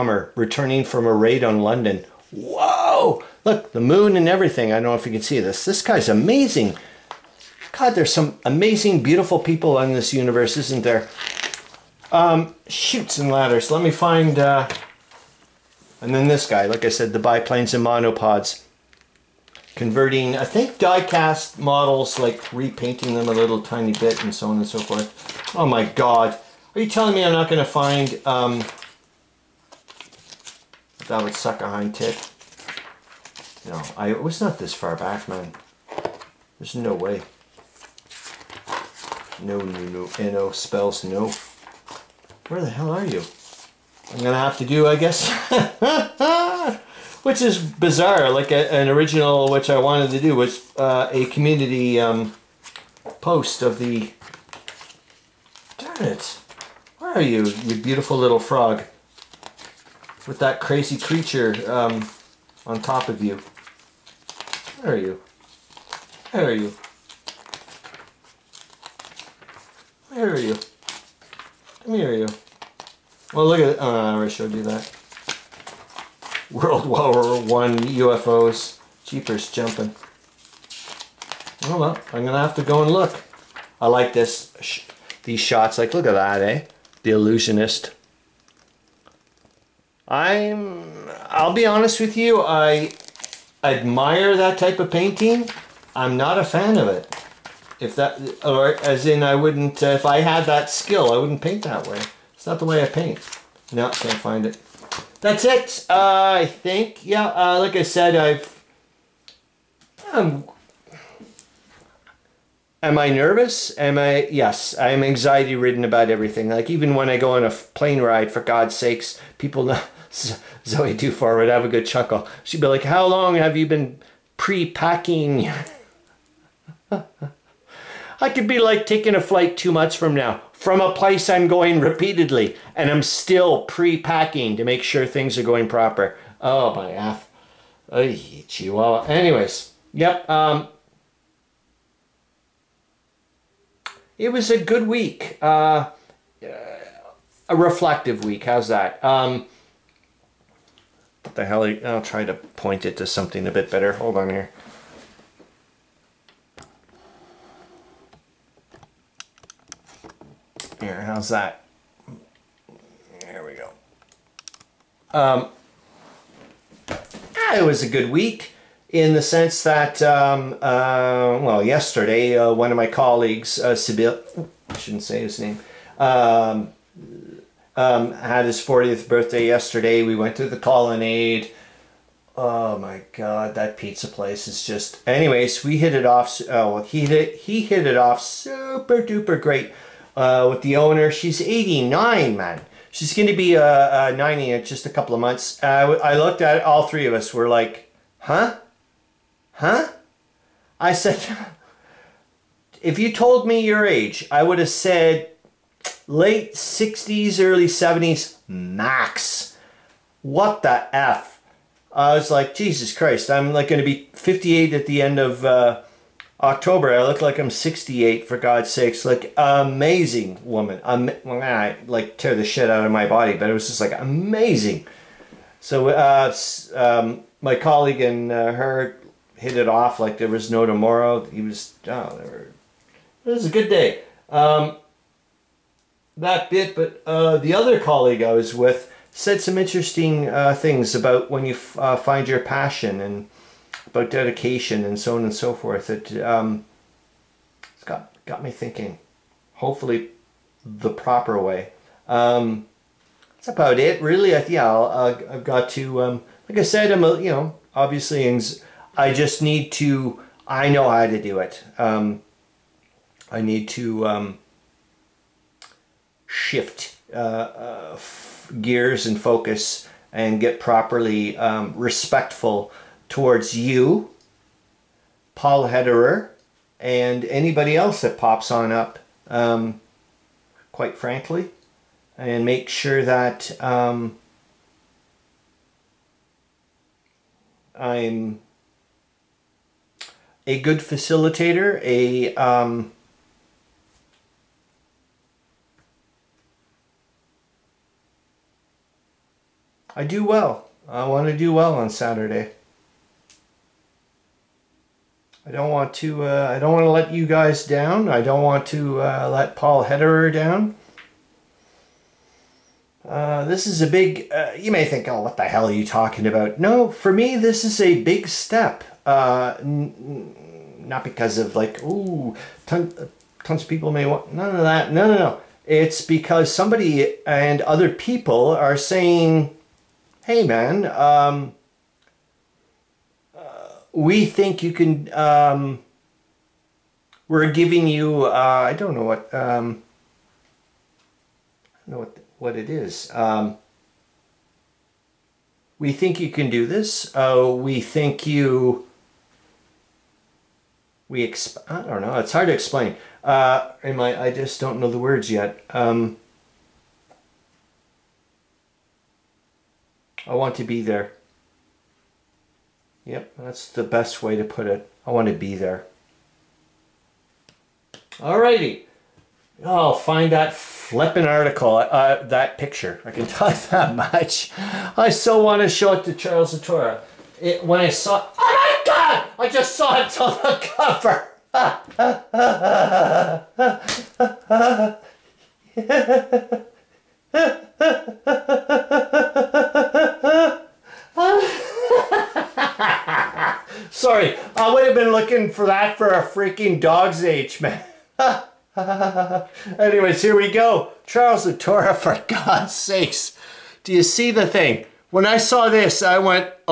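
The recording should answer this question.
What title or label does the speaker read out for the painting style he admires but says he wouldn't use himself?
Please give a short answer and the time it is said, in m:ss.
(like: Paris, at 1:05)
The Illusionist, at 1:27.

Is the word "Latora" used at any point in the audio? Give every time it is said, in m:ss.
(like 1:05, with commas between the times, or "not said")
6:16, 6:41.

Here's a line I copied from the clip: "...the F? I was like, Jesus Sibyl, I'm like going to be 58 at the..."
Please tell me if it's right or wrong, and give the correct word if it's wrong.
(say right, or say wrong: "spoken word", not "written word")
wrong: "Christ", not "Sibyl".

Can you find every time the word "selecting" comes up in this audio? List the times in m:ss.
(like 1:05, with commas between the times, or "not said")
not said.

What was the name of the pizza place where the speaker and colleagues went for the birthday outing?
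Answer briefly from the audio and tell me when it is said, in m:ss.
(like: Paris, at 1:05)
The Colonnade, at 3:00.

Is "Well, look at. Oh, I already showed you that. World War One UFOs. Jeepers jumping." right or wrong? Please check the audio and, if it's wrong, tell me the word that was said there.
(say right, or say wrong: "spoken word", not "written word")
right.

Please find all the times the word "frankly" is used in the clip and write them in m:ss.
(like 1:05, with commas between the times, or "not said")
4:40.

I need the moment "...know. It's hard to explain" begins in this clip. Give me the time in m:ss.
5:52.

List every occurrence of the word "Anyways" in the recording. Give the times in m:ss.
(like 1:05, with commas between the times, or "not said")
2:19, 3:05, 6:39.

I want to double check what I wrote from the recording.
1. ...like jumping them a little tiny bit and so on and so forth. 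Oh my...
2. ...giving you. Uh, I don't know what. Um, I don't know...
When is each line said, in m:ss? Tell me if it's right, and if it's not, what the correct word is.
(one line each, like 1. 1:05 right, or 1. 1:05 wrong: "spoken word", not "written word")
1. 0:22 wrong: "repainting", not "jumping"
2. 5:37 right.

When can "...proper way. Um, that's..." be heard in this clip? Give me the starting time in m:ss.
4:10.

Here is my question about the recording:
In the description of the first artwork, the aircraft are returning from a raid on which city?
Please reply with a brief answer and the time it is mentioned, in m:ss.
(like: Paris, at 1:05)
London, at 0:01.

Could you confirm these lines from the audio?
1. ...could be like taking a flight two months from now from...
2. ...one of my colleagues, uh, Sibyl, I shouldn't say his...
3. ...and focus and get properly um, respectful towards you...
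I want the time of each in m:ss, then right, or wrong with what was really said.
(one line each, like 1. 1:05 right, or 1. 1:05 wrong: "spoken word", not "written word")
1. 2:08 right
2. 2:52 right
3. 4:29 right.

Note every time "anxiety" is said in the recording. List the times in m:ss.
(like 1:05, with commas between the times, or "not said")
1:55.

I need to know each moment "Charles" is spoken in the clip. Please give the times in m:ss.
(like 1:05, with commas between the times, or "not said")
6:16, 6:41.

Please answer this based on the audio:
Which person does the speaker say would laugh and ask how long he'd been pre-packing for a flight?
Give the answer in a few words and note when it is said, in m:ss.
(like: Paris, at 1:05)
Zoe Dufour, at 2:00.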